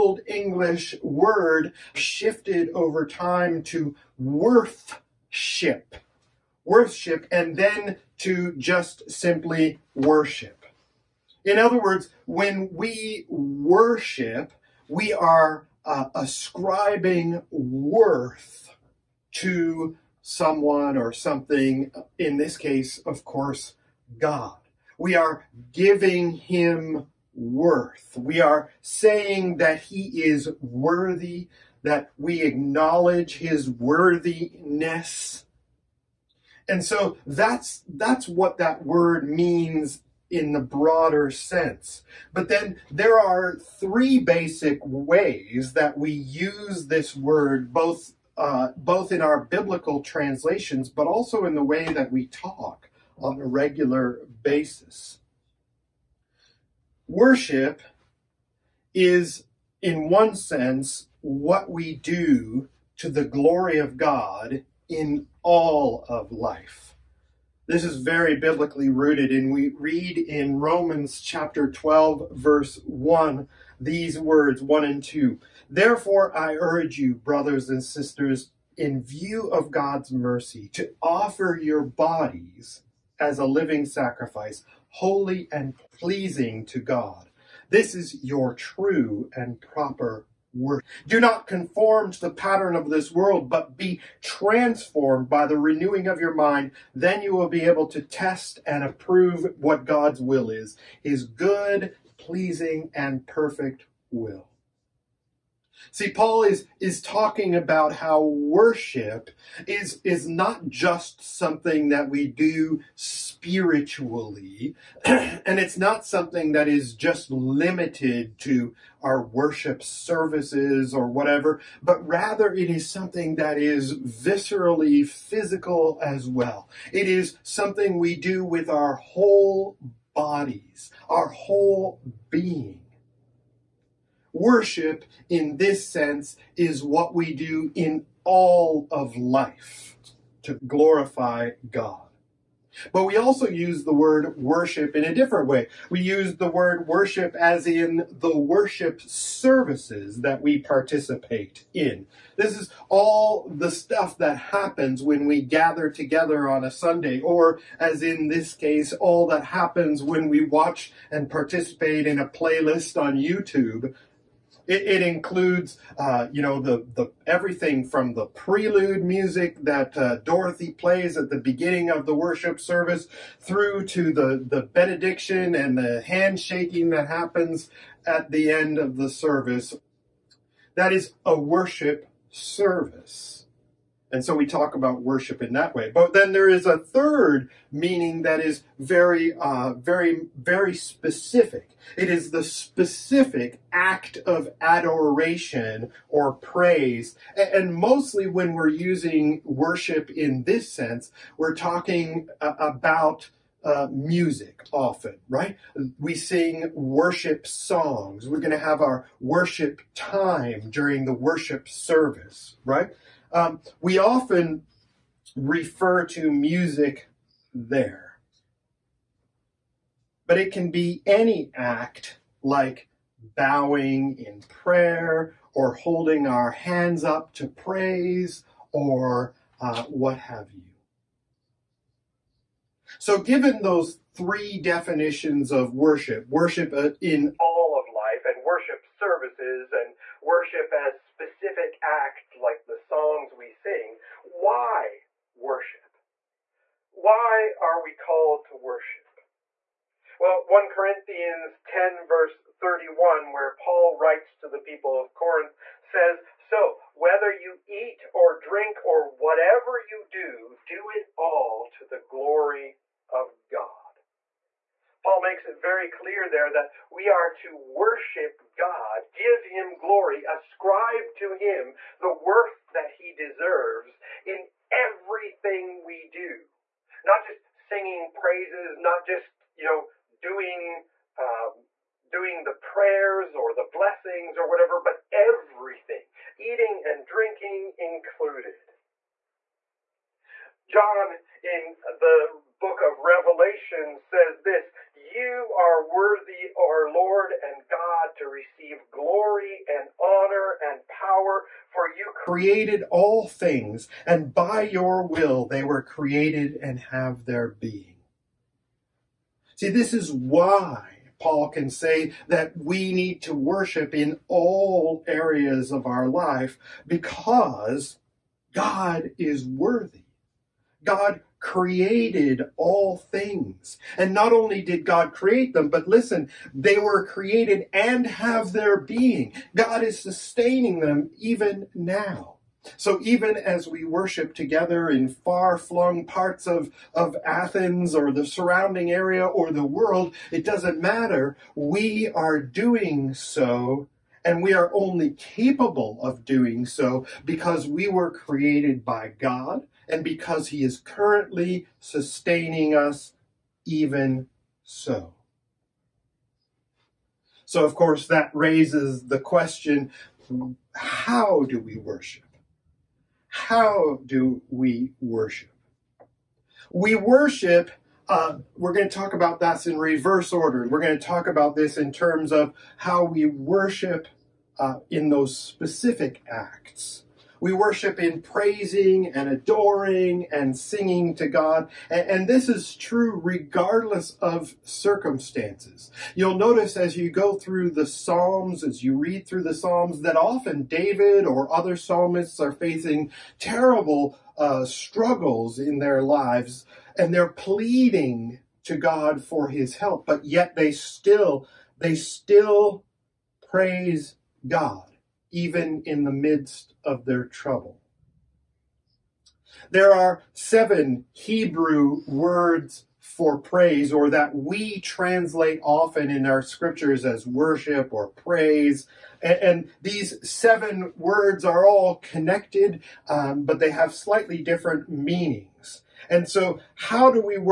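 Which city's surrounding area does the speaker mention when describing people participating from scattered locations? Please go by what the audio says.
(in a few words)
Athens.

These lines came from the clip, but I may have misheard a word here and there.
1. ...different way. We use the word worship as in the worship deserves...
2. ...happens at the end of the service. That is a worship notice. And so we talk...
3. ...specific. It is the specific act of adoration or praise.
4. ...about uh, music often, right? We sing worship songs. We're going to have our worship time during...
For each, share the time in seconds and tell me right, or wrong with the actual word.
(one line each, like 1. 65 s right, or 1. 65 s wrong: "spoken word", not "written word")
1. 145 s wrong: "services", not "deserves"
2. 177 s wrong: "service", not "notice"
3. 190 s right
4. 202 s right.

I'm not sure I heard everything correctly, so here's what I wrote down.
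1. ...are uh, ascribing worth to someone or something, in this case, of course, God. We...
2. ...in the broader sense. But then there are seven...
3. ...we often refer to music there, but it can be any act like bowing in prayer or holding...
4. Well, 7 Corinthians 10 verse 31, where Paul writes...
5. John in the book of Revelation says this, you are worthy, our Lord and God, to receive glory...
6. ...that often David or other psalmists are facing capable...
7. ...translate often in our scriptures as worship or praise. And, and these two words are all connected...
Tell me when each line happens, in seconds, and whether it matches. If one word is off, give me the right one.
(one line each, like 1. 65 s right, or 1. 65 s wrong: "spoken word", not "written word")
1. 15 s right
2. 40 s wrong: "three", not "seven"
3. 213 s right
4. 250 s wrong: "1", not "7"
5. 290 s right
6. 390 s wrong: "terrible", not "capable"
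7. 414 s wrong: "seven", not "two".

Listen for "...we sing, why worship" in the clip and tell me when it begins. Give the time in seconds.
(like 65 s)
243 s.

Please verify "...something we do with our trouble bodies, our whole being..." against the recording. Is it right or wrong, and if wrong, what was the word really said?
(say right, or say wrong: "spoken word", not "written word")
wrong: "whole", not "trouble".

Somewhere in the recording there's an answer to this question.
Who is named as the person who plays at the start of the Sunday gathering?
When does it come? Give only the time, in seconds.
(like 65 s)
170 s.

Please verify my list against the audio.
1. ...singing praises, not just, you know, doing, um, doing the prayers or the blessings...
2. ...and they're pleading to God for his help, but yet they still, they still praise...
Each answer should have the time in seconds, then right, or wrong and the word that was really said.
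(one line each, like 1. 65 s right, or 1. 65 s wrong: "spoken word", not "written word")
1. 277 s right
2. 396 s right.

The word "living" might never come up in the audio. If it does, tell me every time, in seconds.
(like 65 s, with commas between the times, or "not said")
83 s.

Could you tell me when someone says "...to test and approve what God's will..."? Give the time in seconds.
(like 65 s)
97 s.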